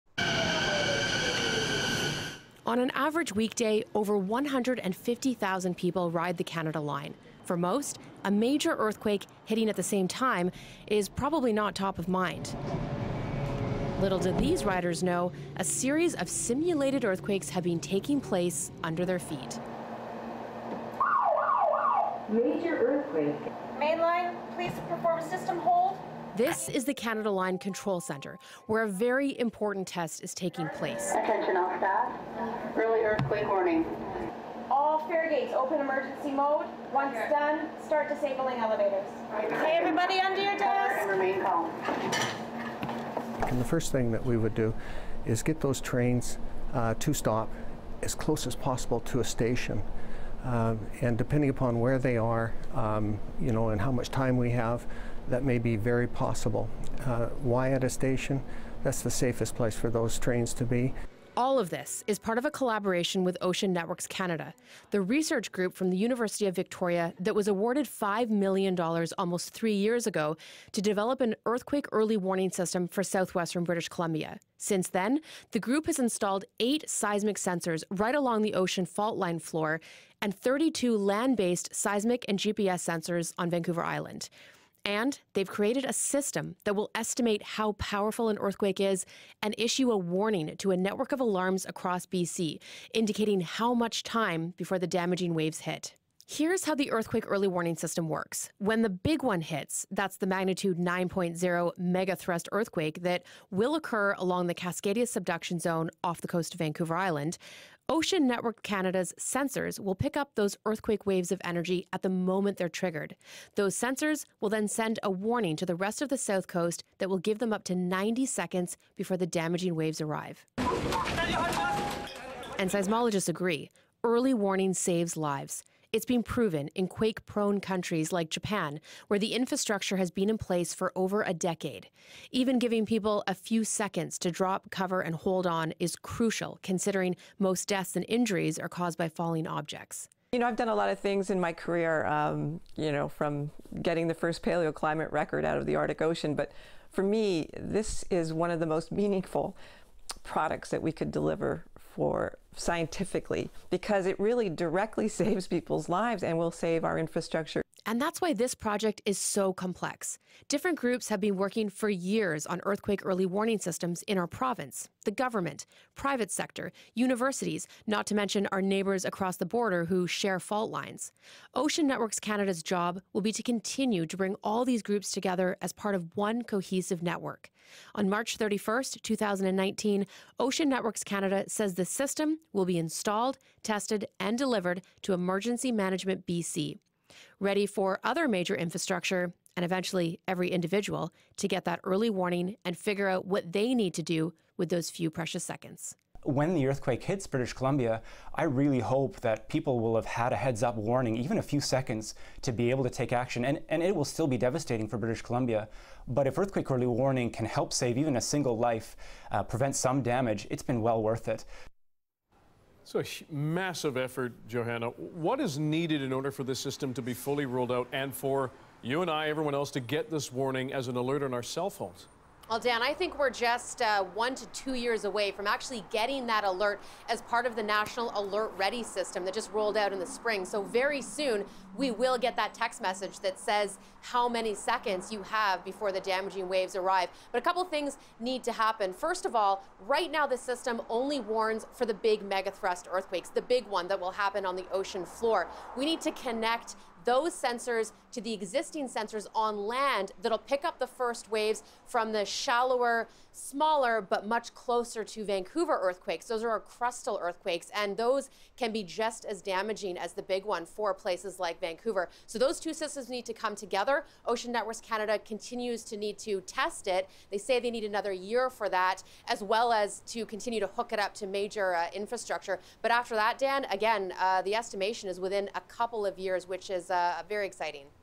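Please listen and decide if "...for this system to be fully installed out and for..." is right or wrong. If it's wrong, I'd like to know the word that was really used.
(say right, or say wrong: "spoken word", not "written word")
wrong: "rolled", not "installed".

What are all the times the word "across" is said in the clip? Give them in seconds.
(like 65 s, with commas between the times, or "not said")
91 s, 169 s.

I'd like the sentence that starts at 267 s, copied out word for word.
They say they need another year for that, as well as to continue to hook it up to major uh, infrastructure.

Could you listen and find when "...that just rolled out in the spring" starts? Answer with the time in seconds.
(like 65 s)
229 s.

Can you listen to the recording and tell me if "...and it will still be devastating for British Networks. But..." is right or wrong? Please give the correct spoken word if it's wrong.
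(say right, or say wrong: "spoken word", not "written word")
wrong: "Columbia", not "Networks".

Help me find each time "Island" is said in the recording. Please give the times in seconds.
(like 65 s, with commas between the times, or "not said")
83 s, 106 s.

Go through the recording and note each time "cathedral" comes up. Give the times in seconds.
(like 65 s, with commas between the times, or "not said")
not said.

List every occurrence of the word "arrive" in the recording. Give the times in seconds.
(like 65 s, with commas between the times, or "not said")
119 s, 236 s.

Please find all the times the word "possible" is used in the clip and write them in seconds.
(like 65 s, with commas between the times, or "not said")
48 s, 56 s.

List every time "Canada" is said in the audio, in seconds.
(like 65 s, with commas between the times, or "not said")
6 s, 26 s, 64 s, 108 s, 172 s, 181 s, 264 s.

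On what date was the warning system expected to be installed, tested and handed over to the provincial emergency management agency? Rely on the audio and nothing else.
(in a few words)
March 31, 2019.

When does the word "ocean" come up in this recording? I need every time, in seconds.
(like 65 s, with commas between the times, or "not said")
63 s, 78 s, 107 s, 146 s, 171 s, 180 s, 244 s, 264 s.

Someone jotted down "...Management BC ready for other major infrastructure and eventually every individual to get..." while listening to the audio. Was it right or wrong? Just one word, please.
right.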